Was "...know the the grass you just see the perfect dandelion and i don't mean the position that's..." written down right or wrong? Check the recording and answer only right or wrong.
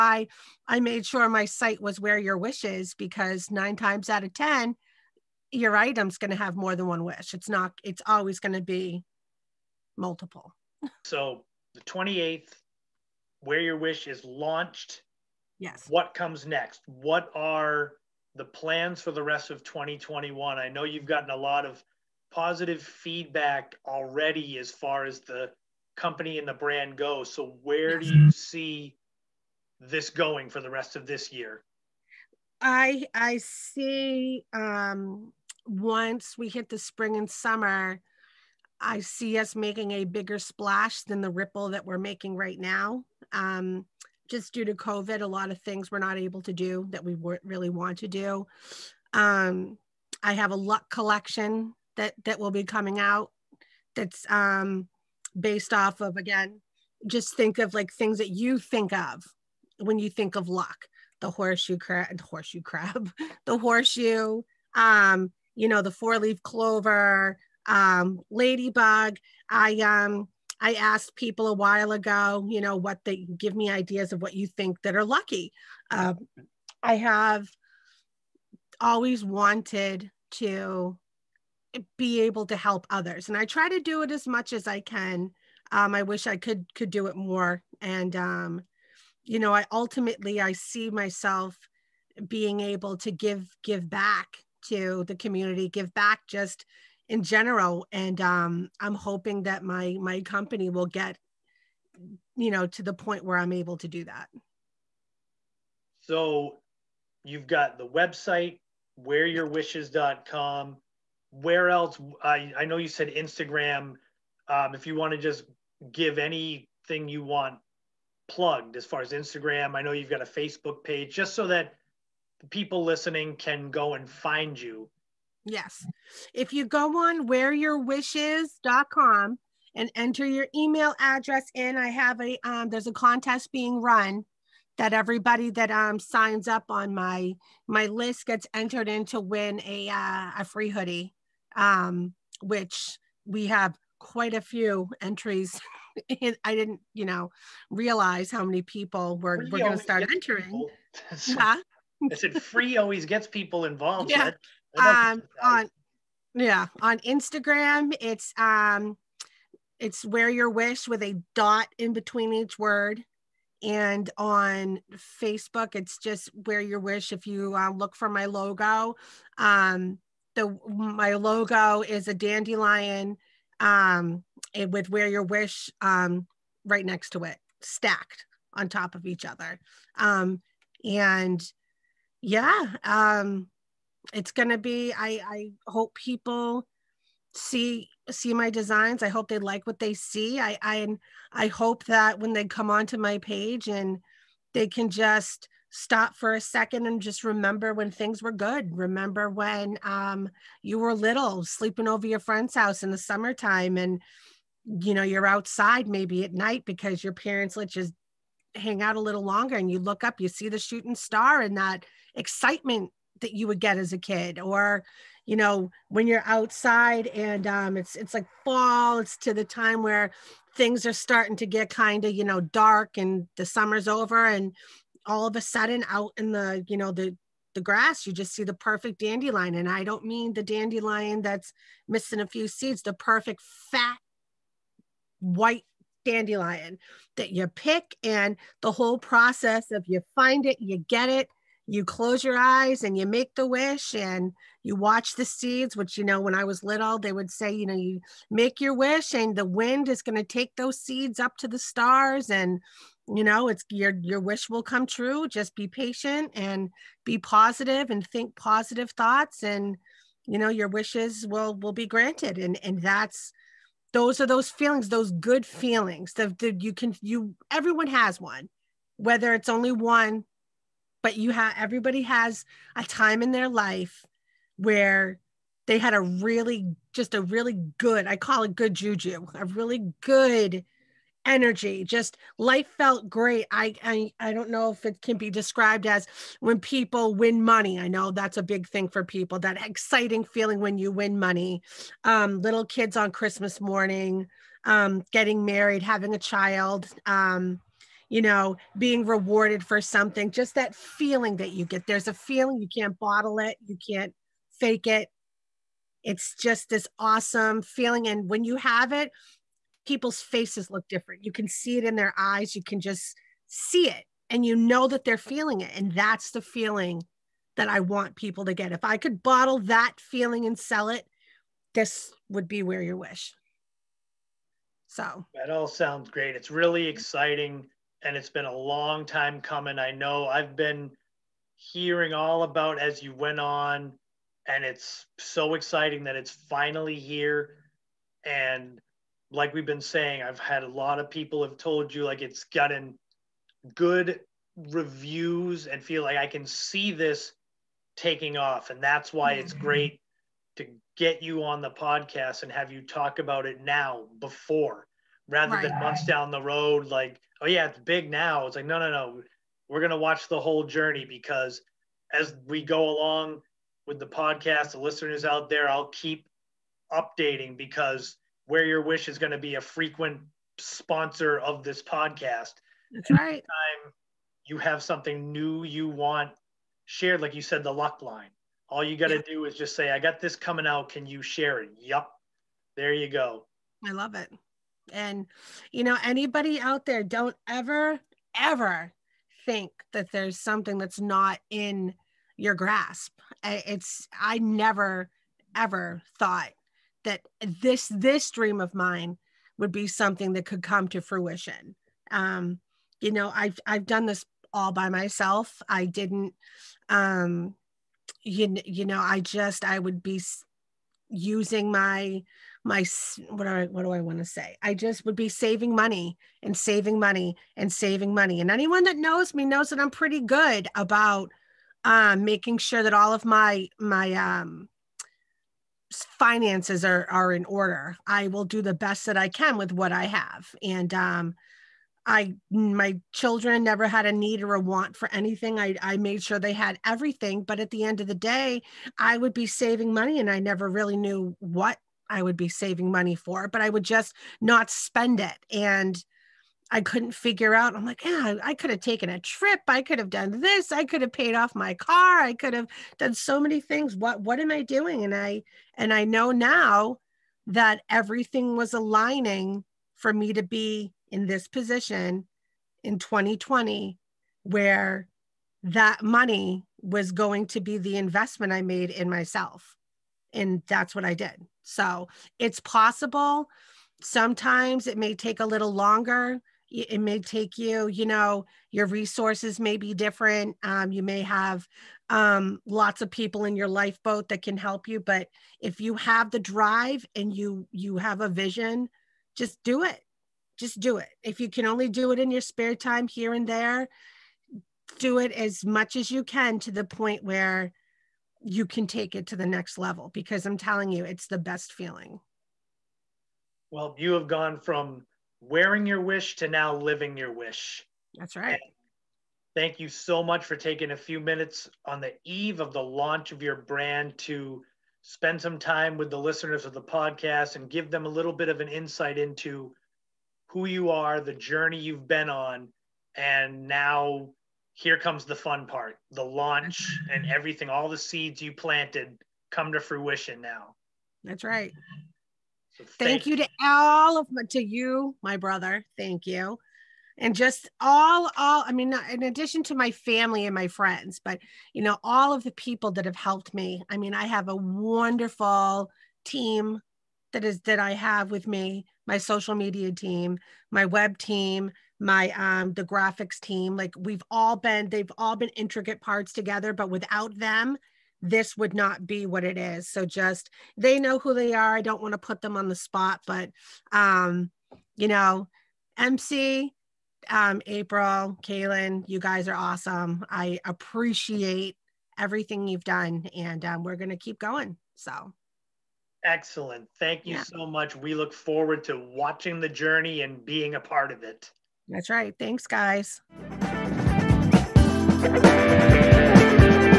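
wrong.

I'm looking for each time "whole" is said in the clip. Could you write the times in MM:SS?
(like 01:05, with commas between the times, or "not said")
03:58, 06:00.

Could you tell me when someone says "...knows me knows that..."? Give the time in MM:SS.
06:58.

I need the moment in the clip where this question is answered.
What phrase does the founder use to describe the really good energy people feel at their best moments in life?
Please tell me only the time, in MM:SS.
04:38.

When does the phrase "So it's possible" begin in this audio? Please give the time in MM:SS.
07:51.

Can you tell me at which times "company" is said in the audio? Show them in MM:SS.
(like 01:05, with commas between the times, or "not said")
00:25, 01:40.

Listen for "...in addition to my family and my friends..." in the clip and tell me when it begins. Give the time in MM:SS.
08:59.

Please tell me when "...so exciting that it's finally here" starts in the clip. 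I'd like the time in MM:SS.
05:35.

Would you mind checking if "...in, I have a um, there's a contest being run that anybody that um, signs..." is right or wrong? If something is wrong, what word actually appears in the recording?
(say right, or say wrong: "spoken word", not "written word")
wrong: "everybody", not "anybody".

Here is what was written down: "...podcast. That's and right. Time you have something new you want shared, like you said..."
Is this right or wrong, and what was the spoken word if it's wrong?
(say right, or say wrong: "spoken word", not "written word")
right.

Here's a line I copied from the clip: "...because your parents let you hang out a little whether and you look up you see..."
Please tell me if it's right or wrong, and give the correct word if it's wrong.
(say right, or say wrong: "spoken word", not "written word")
wrong: "longer", not "whether".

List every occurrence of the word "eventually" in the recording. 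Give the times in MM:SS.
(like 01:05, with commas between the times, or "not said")
not said.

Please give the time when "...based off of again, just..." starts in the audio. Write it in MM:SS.
00:55.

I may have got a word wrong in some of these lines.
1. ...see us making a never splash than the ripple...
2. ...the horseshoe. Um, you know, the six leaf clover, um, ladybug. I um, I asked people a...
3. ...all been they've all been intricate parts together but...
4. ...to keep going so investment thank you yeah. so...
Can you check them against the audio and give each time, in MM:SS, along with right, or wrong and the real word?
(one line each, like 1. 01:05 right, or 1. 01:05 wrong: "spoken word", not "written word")
1. 00:38 wrong: "bigger", not "never"
2. 01:03 wrong: "four", not "six"
3. 09:14 right
4. 09:34 wrong: "excellent", not "investment".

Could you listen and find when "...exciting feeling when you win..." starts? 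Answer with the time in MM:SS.
04:49.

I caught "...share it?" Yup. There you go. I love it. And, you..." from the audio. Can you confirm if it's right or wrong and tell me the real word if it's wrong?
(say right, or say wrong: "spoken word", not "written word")
right.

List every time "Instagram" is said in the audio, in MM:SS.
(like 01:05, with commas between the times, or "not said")
01:53, 01:59, 02:36.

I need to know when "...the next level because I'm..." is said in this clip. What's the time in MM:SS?
08:19.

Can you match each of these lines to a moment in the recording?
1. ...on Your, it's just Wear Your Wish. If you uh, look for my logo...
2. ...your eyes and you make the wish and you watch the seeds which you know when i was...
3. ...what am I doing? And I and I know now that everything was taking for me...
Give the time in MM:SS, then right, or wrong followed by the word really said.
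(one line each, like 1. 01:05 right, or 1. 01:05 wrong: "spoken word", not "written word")
1. 02:44 wrong: "Facebook", not "Your"
2. 04:02 right
3. 07:34 wrong: "aligning", not "taking".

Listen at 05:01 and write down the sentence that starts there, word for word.
There's a feeling you can't bottle it, you can't fake it.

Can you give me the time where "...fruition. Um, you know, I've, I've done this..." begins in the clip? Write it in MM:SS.
06:41.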